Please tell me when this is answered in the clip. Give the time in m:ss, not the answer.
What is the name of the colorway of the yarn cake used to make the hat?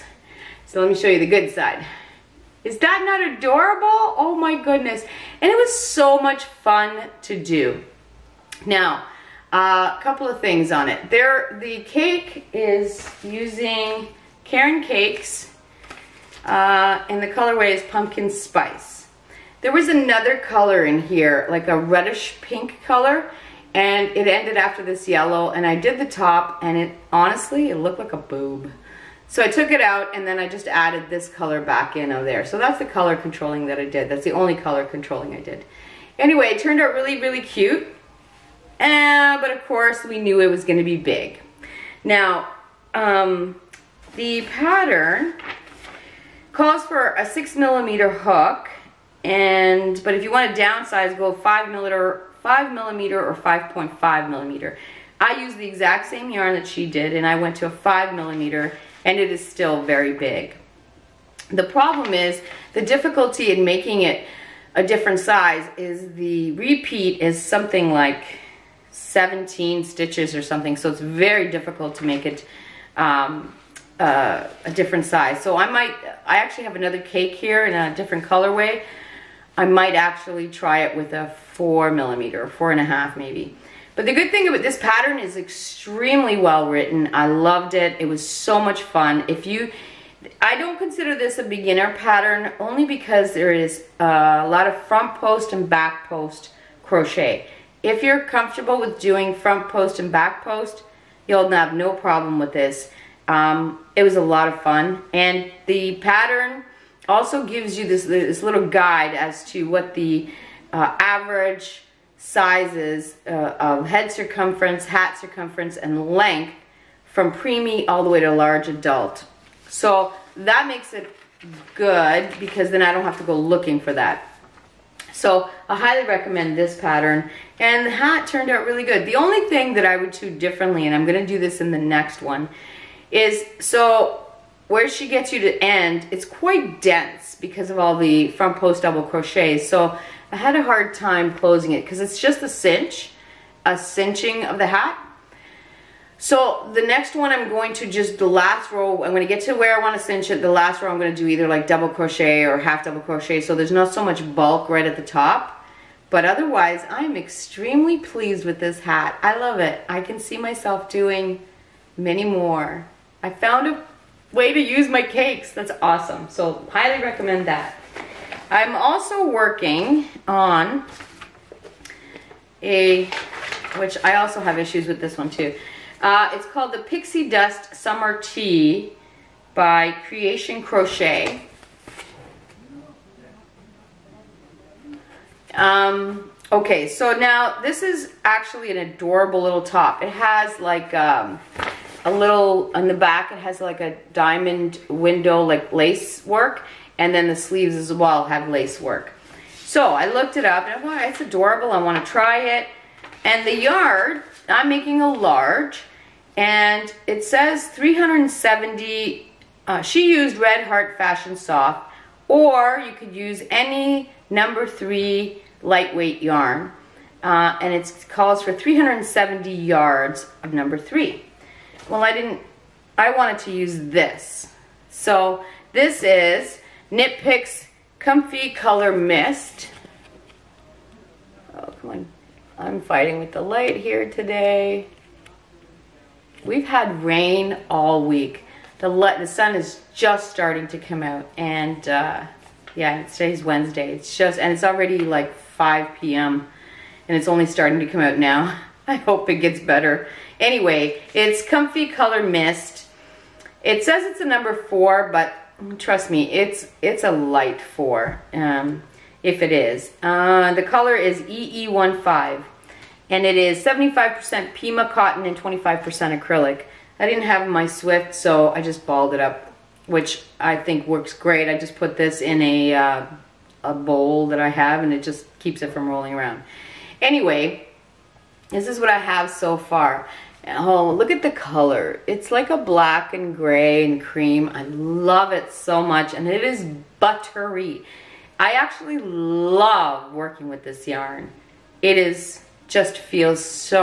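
0:17.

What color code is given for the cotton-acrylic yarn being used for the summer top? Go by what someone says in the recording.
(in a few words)
EE15.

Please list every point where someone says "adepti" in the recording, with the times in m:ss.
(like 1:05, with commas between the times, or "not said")
not said.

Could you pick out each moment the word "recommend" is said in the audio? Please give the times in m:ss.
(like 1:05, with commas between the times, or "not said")
2:06, 2:47.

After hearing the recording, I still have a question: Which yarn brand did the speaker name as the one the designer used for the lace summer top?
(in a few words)
Red Heart Fashion Soft.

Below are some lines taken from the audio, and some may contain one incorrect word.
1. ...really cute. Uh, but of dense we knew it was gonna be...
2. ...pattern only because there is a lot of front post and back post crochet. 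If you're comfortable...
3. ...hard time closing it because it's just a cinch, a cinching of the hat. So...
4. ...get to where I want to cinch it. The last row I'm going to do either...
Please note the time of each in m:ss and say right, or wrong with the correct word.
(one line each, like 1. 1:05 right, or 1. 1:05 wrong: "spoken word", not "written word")
1. 0:37 wrong: "course", not "dense"
2. 1:31 right
3. 2:20 right
4. 2:29 right.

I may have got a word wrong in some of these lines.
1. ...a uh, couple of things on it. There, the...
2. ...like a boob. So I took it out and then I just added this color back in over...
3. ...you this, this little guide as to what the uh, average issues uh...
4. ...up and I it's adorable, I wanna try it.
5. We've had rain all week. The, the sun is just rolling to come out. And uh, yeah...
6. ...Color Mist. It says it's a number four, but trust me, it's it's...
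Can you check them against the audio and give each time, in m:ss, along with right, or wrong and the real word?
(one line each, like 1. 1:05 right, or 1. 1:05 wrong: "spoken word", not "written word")
1. 0:09 right
2. 0:27 right
3. 1:47 wrong: "sizes", not "issues"
4. 3:20 right
5. 3:56 wrong: "starting", not "rolling"
6. 4:11 right.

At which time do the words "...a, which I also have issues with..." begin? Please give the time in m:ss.
2:52.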